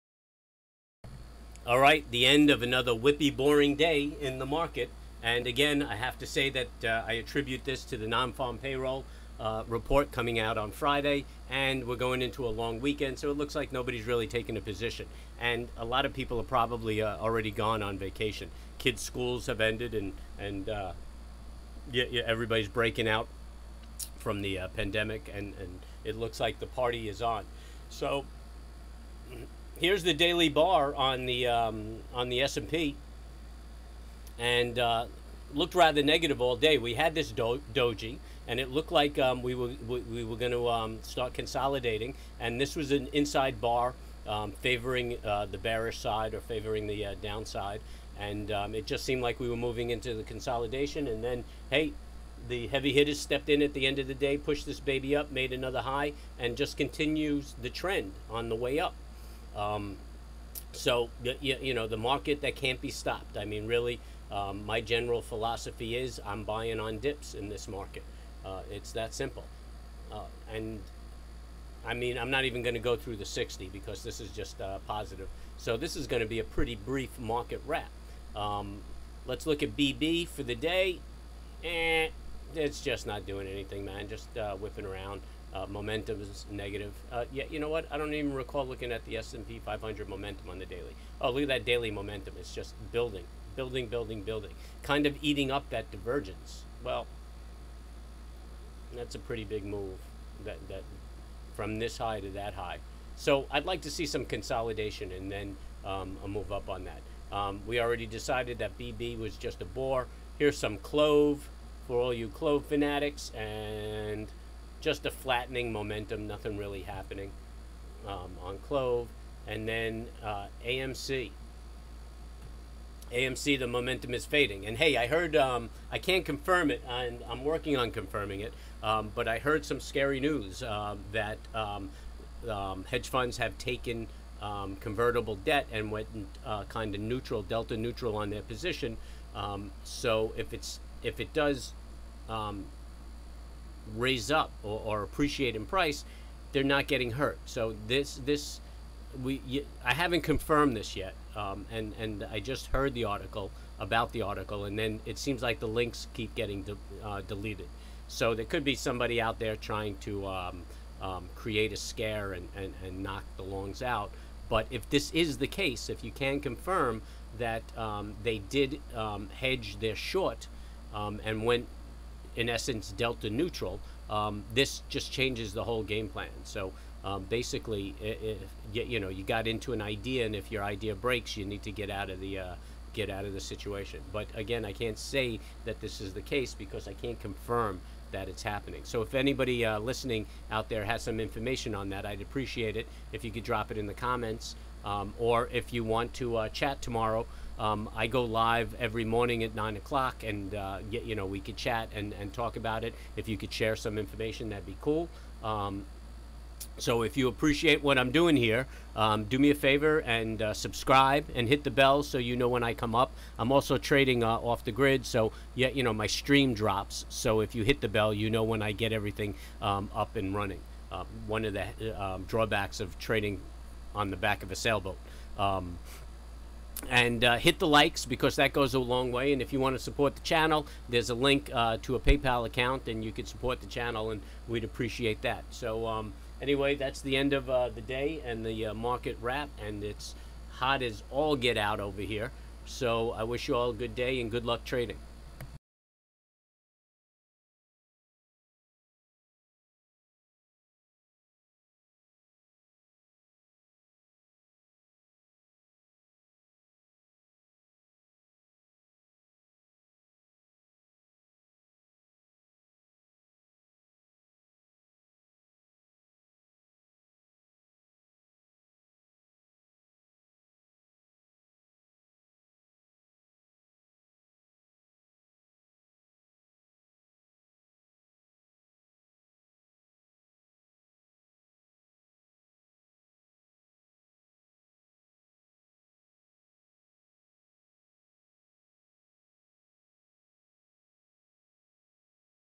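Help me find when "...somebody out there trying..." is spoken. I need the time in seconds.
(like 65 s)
158 s.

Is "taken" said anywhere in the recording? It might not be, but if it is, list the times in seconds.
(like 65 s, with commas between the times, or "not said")
14 s, 133 s.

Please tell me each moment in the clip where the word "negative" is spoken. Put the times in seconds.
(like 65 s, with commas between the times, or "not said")
36 s, 86 s.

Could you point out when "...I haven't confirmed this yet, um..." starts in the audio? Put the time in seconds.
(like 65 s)
149 s.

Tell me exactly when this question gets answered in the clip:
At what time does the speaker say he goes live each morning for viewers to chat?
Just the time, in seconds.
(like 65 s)
199 s.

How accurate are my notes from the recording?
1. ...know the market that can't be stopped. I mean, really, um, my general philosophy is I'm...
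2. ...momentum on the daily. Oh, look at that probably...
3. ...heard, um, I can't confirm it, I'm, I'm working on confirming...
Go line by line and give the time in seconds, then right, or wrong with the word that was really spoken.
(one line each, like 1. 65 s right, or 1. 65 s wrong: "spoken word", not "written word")
1. 61 s right
2. 90 s wrong: "daily", not "probably"
3. 125 s right.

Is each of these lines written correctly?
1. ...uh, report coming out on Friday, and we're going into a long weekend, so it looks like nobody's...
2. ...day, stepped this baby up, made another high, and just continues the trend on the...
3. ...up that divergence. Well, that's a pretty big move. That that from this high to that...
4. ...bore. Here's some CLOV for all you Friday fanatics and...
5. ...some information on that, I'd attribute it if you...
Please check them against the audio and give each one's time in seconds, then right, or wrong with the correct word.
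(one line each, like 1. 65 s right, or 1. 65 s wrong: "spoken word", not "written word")
1. 9 s right
2. 54 s wrong: "pushed", not "stepped"
3. 95 s right
4. 109 s wrong: "CLOV", not "Friday"
5. 191 s wrong: "appreciate", not "attribute".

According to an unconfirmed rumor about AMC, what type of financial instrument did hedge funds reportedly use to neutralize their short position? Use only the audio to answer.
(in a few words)
Convertible debt.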